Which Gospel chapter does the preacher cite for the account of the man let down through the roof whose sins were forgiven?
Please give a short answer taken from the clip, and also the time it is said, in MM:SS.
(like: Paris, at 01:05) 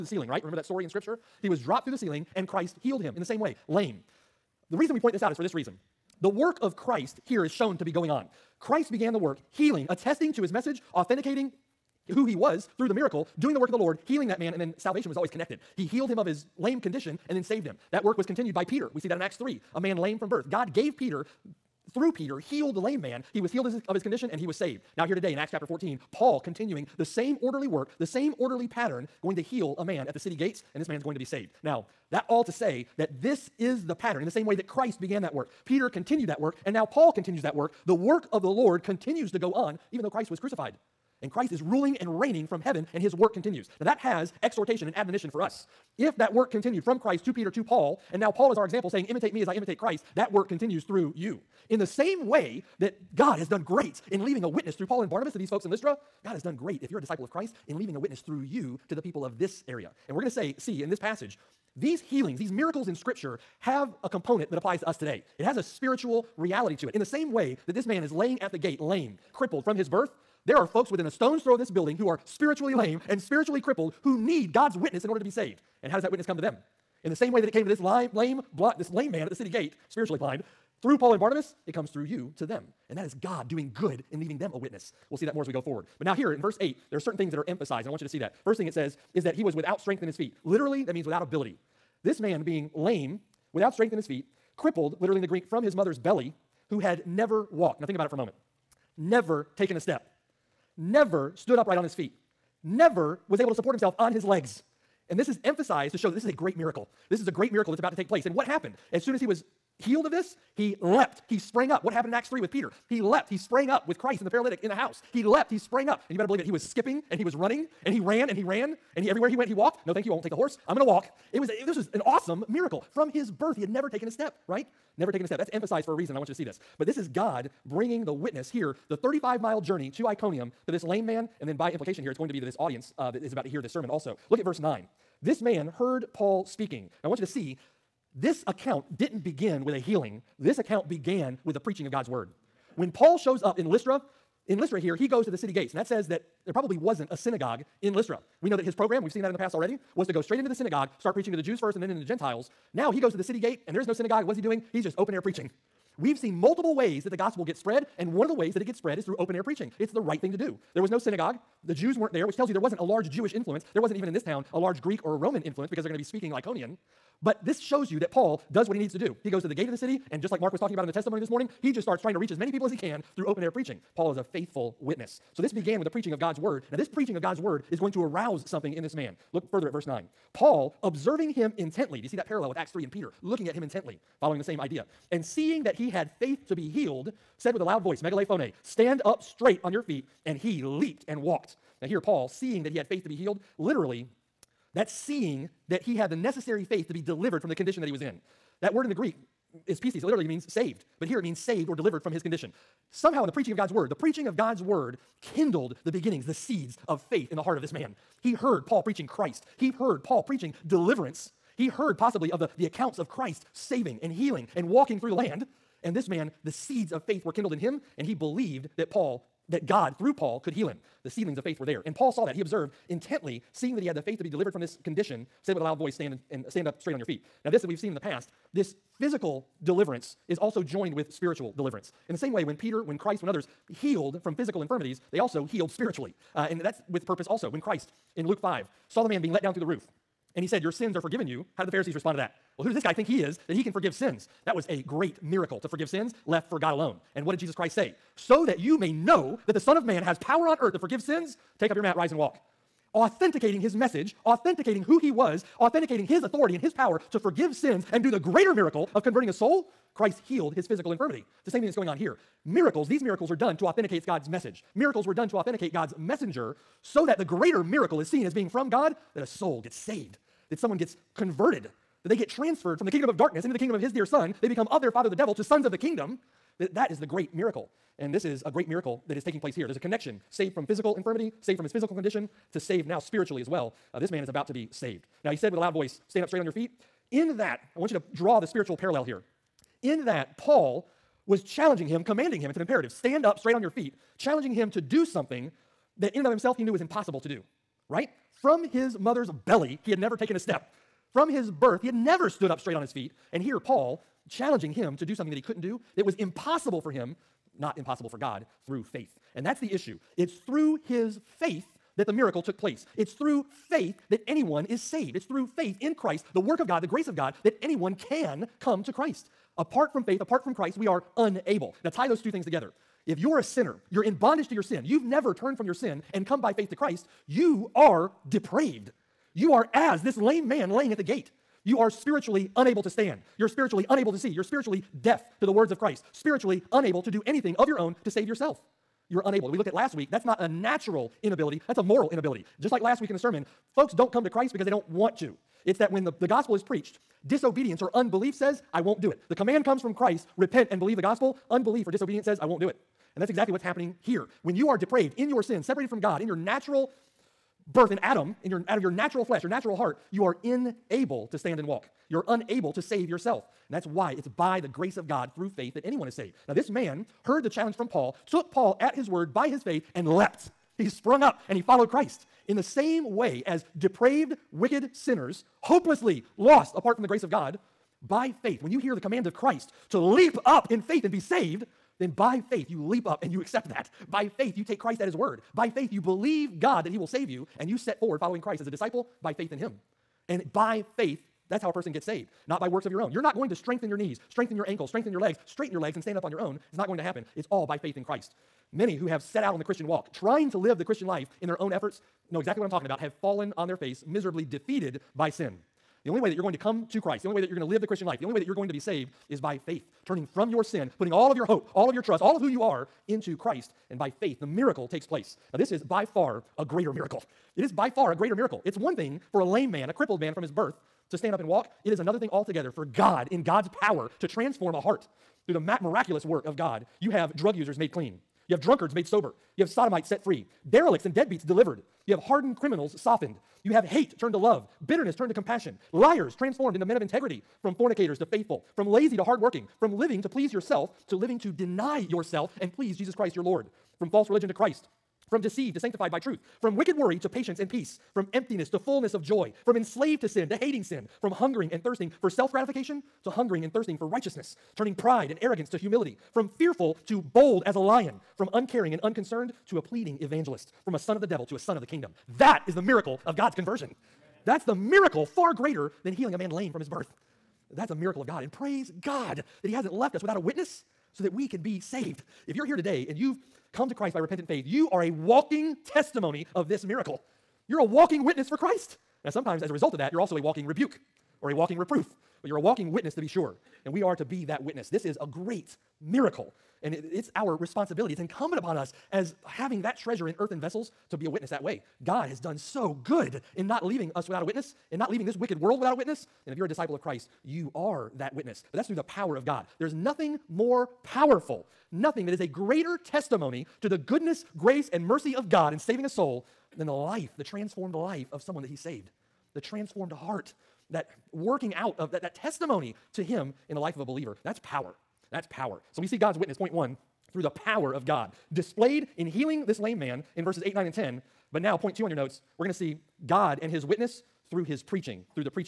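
Luke 5, at 03:58.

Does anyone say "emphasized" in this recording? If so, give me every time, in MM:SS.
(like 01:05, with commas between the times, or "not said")
01:27, 01:45, 02:05.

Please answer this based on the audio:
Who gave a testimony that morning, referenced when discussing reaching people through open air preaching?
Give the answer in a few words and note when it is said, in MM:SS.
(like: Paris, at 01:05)
Mark, at 02:50.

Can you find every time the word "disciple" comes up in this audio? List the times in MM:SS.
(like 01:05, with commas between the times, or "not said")
00:57, 06:28, 08:16.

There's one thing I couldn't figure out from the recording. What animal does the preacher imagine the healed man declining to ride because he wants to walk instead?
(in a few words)
horse.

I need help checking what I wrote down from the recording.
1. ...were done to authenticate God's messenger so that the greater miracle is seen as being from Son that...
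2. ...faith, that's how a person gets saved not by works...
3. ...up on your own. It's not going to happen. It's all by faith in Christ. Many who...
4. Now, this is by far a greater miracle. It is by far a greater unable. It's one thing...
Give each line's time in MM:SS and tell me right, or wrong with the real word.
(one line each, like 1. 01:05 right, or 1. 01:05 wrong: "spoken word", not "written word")
1. 04:25 wrong: "God", not "Son"
2. 06:30 right
3. 06:36 right
4. 06:55 wrong: "miracle", not "unable".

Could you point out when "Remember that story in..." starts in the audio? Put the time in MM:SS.
00:00.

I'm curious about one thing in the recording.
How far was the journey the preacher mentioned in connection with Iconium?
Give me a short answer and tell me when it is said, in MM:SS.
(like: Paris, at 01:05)
35 miles, at 02:08.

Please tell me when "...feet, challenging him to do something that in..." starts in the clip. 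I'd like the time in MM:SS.
04:53.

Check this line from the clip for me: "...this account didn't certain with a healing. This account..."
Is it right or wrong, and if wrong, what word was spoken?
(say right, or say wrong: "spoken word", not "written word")
wrong: "begin", not "certain".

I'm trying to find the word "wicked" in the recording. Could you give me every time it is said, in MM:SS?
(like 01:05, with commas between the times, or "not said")
06:14, 07:26, 08:15.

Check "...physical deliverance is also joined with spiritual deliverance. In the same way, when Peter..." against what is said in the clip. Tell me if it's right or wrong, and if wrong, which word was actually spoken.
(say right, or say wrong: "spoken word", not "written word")
right.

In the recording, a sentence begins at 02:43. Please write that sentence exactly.
There wasn't even in this town a large Greek or Roman influence because they're going to be speaking Lycaonian.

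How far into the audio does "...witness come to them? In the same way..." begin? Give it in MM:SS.
01:16.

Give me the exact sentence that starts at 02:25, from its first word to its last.
And that says that there probably wasn't a synagogue in Lystra.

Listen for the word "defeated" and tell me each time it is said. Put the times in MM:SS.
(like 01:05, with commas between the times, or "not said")
06:44.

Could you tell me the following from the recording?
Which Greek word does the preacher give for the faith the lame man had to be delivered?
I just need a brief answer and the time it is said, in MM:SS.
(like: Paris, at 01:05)
pistis, at 03:19.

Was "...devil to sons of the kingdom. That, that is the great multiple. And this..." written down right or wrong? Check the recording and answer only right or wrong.
wrong.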